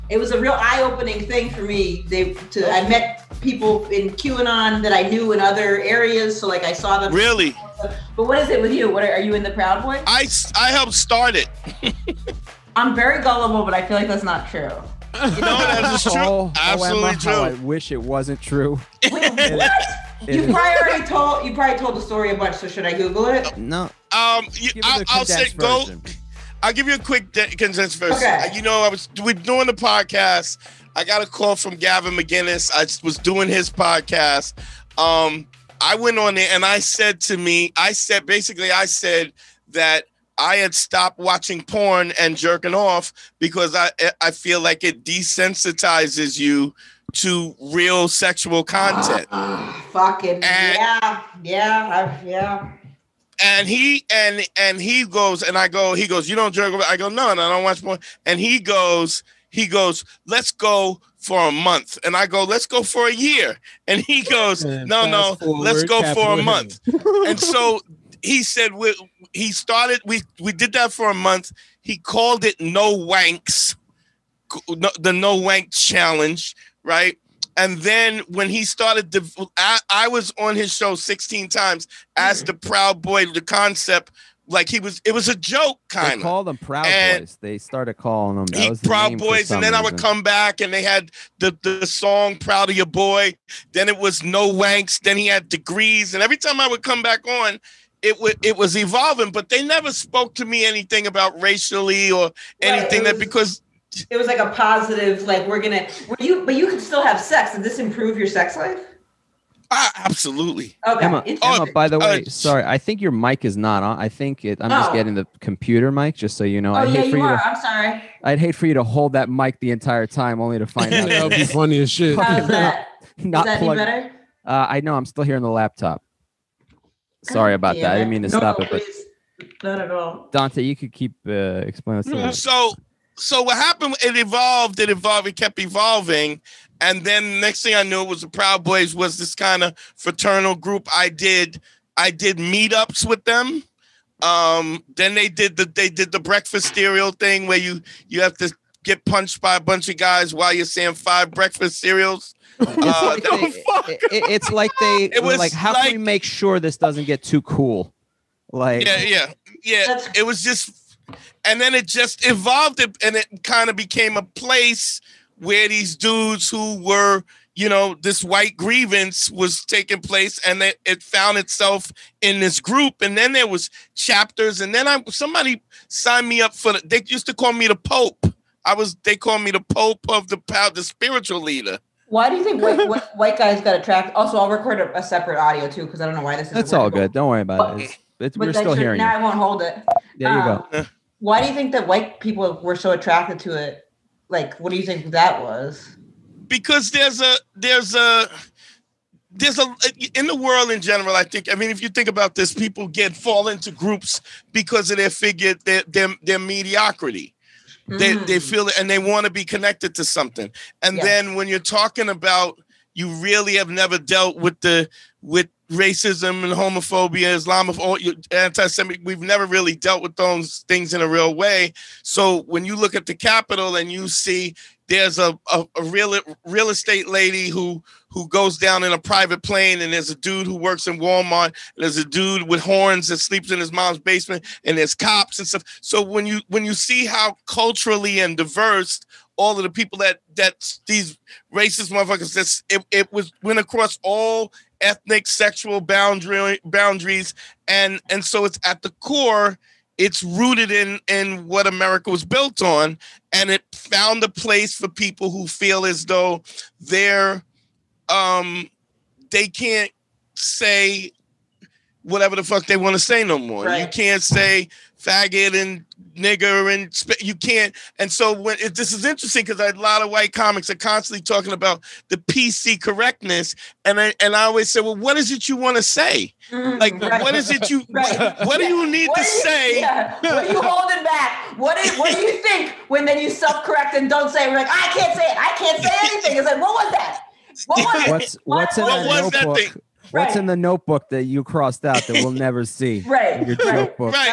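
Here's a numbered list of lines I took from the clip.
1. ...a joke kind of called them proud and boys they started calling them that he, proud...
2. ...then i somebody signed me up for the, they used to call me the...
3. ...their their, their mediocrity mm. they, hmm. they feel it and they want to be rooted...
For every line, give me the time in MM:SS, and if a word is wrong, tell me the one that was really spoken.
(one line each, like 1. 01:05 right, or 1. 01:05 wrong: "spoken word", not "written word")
1. 01:25 right
2. 02:54 right
3. 03:25 wrong: "connected", not "rooted".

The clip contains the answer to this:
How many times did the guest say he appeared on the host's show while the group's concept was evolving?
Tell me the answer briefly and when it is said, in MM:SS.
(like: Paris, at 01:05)
16, at 01:20.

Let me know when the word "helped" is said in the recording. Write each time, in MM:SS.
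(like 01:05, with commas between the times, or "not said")
00:10.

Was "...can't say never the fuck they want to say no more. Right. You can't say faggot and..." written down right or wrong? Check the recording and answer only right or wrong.
wrong.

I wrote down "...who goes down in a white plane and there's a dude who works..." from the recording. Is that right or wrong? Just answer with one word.
wrong.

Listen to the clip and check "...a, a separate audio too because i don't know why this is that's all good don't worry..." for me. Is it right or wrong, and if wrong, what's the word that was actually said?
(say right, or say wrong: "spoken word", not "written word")
right.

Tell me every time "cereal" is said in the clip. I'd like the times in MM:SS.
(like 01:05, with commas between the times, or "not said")
02:26, 02:31.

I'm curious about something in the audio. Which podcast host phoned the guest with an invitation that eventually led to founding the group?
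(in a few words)
Gavin McInnes.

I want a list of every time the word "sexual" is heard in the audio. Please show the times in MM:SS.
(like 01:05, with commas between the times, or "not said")
00:48, 04:05.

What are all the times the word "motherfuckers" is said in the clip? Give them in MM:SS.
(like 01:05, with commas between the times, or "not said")
04:01.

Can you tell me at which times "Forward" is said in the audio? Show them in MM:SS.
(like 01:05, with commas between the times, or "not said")
01:05.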